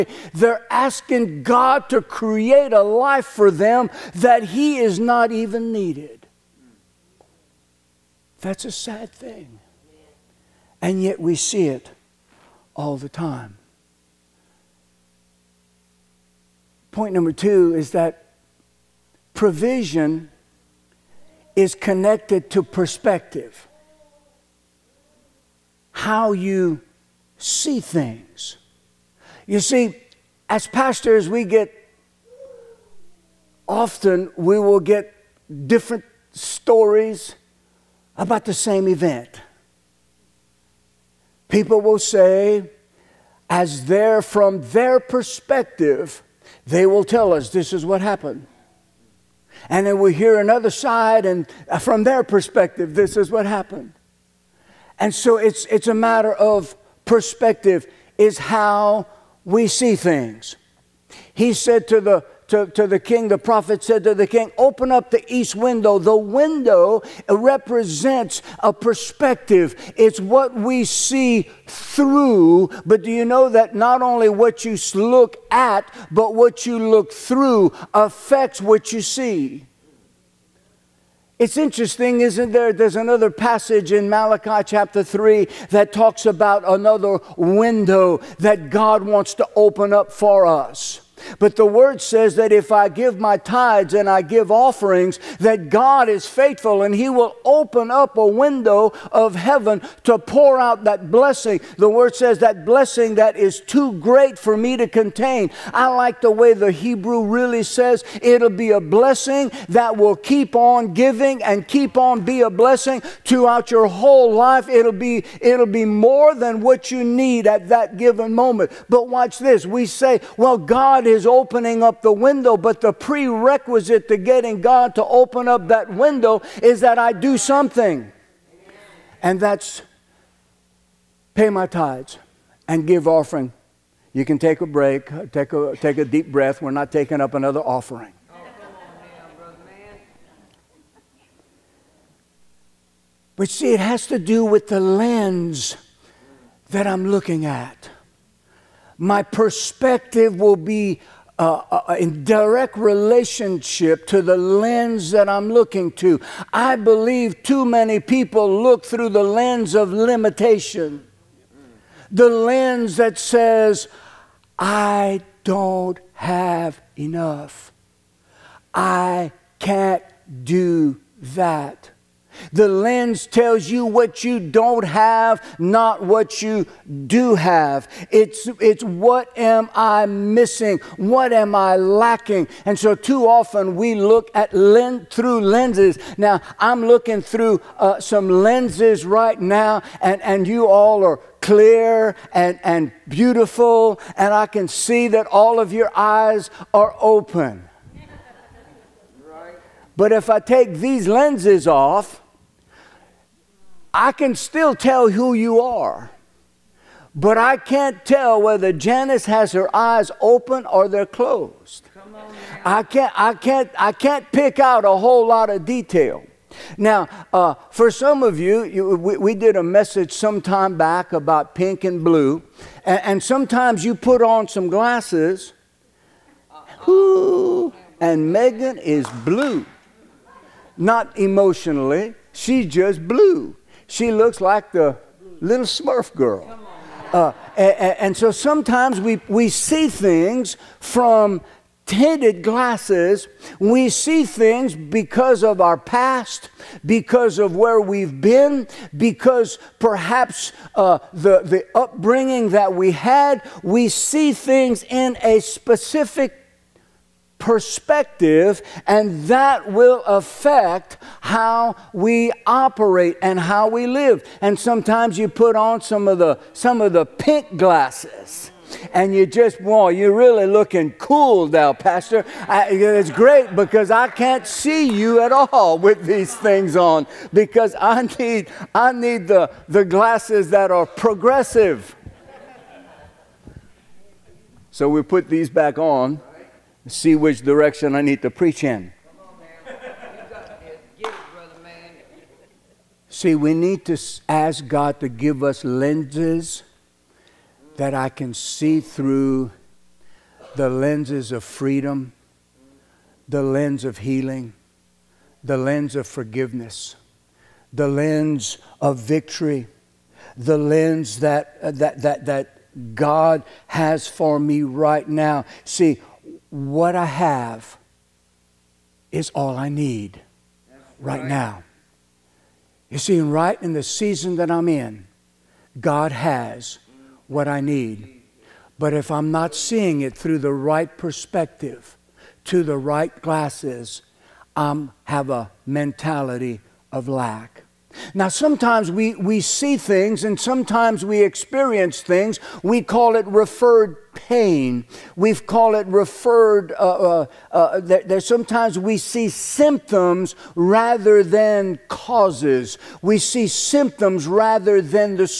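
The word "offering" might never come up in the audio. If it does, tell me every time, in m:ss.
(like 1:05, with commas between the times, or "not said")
1:34, 2:13, 2:17.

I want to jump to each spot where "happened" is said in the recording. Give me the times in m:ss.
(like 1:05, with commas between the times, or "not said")
0:48, 0:53.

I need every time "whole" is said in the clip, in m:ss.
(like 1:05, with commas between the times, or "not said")
1:53, 3:34.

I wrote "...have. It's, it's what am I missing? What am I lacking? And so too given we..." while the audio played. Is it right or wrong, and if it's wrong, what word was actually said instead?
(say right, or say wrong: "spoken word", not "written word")
wrong: "often", not "given".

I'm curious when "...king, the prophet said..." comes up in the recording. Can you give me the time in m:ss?
1:02.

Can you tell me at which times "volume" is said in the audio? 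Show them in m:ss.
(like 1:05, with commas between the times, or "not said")
not said.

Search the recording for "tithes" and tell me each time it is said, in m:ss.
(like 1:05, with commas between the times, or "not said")
1:33, 2:11.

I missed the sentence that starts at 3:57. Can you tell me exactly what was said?
Uh, and, and, so sometimes we, we see things from tinted glasses.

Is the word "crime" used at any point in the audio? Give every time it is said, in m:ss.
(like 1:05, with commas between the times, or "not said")
not said.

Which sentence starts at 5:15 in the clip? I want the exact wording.
See, what I have is all I need right, right now.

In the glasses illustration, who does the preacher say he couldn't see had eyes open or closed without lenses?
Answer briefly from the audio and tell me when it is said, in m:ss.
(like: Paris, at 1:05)
Janice, at 3:28.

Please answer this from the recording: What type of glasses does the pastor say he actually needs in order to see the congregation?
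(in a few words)
Progressive.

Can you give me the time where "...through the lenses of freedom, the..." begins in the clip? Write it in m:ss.
4:58.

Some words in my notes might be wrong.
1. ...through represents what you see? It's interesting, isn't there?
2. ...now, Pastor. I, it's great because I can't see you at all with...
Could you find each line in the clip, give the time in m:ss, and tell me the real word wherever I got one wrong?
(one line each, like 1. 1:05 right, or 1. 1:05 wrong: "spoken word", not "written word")
1. 1:17 wrong: "affects", not "represents"
2. 4:31 right.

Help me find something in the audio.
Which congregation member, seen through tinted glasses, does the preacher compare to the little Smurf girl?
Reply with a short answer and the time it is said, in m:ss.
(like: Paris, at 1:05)
Megan, at 3:48.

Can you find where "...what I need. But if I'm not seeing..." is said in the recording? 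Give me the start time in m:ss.
5:27.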